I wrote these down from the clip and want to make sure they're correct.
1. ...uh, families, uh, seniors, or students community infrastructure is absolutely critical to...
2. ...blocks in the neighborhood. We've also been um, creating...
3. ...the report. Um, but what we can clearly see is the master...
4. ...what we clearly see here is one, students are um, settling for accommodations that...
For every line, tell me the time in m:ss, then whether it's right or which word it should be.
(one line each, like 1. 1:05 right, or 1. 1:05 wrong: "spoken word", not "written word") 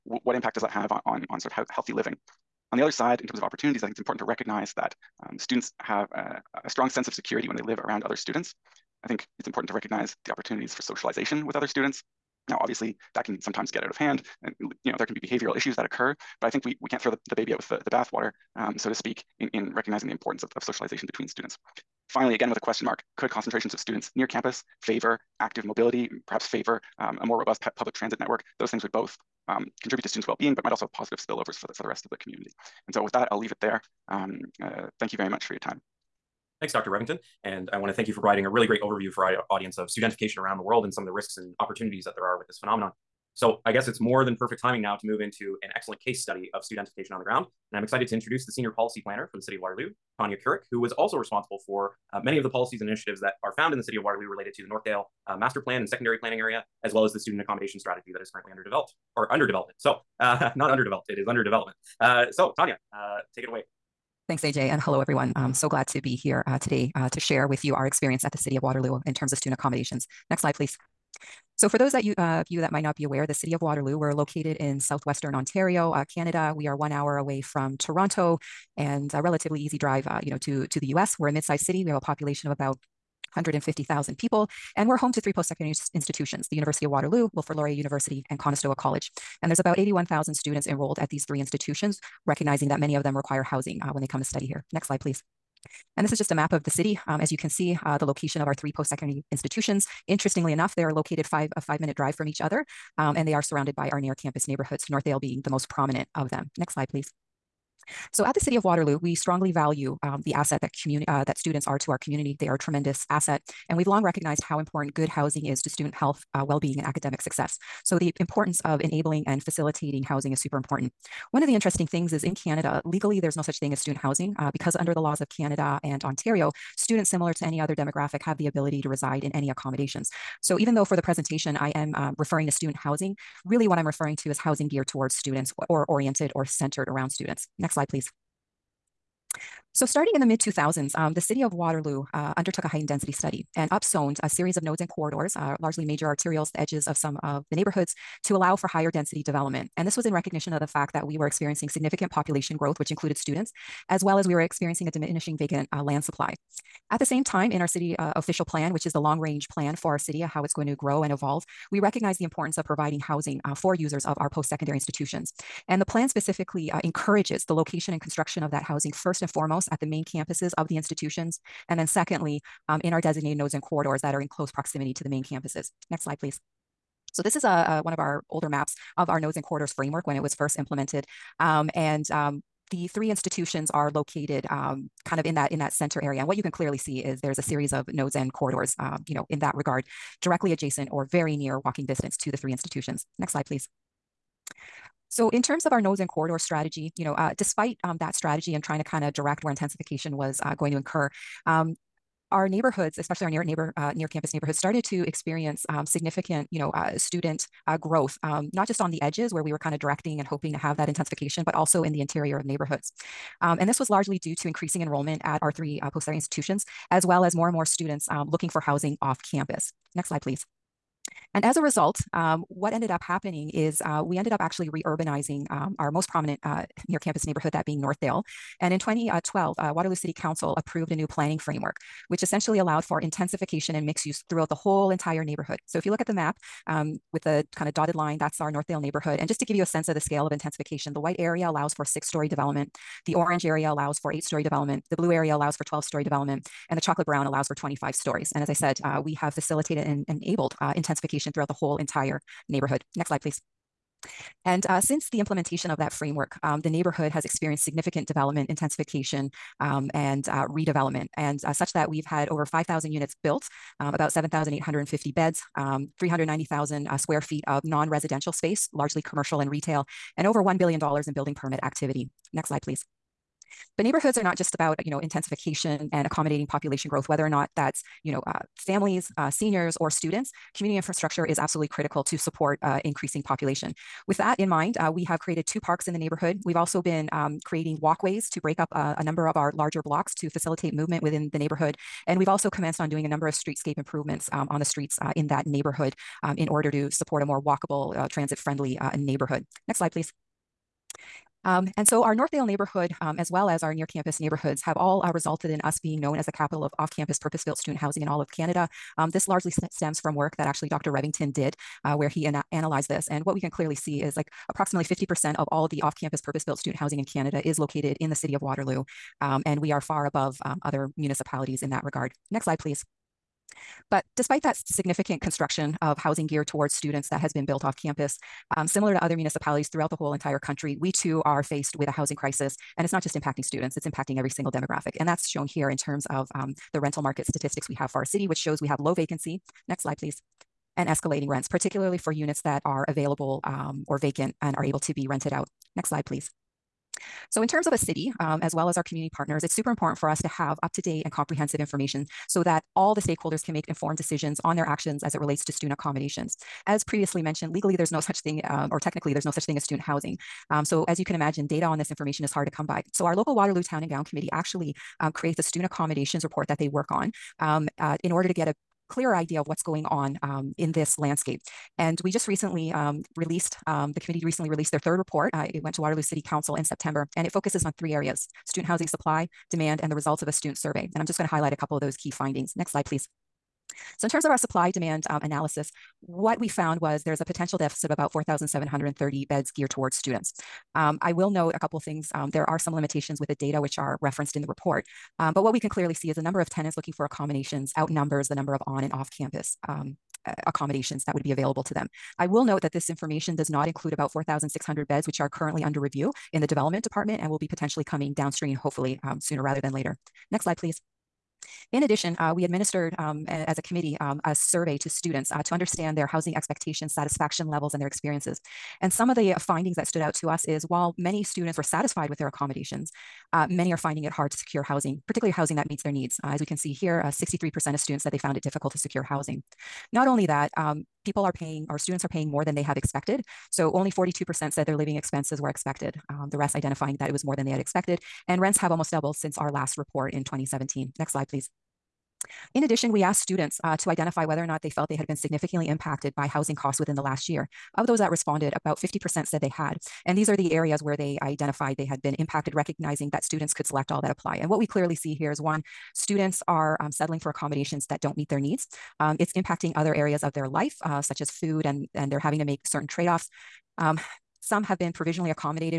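1. 4:38 right
2. 4:45 wrong: "parks", not "blocks"
3. 6:34 wrong: "number", not "master"
4. 7:34 right.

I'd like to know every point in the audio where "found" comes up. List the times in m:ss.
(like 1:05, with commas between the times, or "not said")
0:53, 6:26, 7:08.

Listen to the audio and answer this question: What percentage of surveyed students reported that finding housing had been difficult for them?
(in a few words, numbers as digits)
63%.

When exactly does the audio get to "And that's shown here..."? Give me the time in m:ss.
5:34.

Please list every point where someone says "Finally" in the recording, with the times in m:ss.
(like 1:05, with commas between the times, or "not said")
0:22.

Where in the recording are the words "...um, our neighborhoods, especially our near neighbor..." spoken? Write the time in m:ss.
3:21.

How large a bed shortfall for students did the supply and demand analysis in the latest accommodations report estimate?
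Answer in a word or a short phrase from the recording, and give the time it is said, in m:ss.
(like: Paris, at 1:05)
4,730 beds, at 6:28.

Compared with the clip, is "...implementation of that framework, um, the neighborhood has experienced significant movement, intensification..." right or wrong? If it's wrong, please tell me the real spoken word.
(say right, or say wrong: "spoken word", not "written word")
wrong: "development", not "movement".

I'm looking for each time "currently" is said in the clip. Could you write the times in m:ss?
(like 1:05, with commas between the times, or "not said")
0:58, 6:45.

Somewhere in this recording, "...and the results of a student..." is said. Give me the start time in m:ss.
6:19.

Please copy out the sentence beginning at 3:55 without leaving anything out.
So if you look at the map, um, with the kind of dotted line, that's our Northdale neighborhood.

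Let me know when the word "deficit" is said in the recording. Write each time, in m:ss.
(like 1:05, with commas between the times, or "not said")
6:27.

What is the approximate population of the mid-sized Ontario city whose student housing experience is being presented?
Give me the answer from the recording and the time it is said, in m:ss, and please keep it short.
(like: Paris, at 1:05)
150,000, at 1:23.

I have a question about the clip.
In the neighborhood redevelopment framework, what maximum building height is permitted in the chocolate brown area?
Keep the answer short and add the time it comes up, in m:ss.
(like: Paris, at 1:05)
25 stories, at 4:07.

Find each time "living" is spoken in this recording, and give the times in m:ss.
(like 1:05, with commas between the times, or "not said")
0:01, 7:14.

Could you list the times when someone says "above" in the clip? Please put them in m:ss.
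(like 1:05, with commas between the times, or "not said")
5:20.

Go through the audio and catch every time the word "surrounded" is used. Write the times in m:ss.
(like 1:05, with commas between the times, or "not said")
1:43.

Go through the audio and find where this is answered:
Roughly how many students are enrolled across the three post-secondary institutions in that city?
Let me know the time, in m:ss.
1:29.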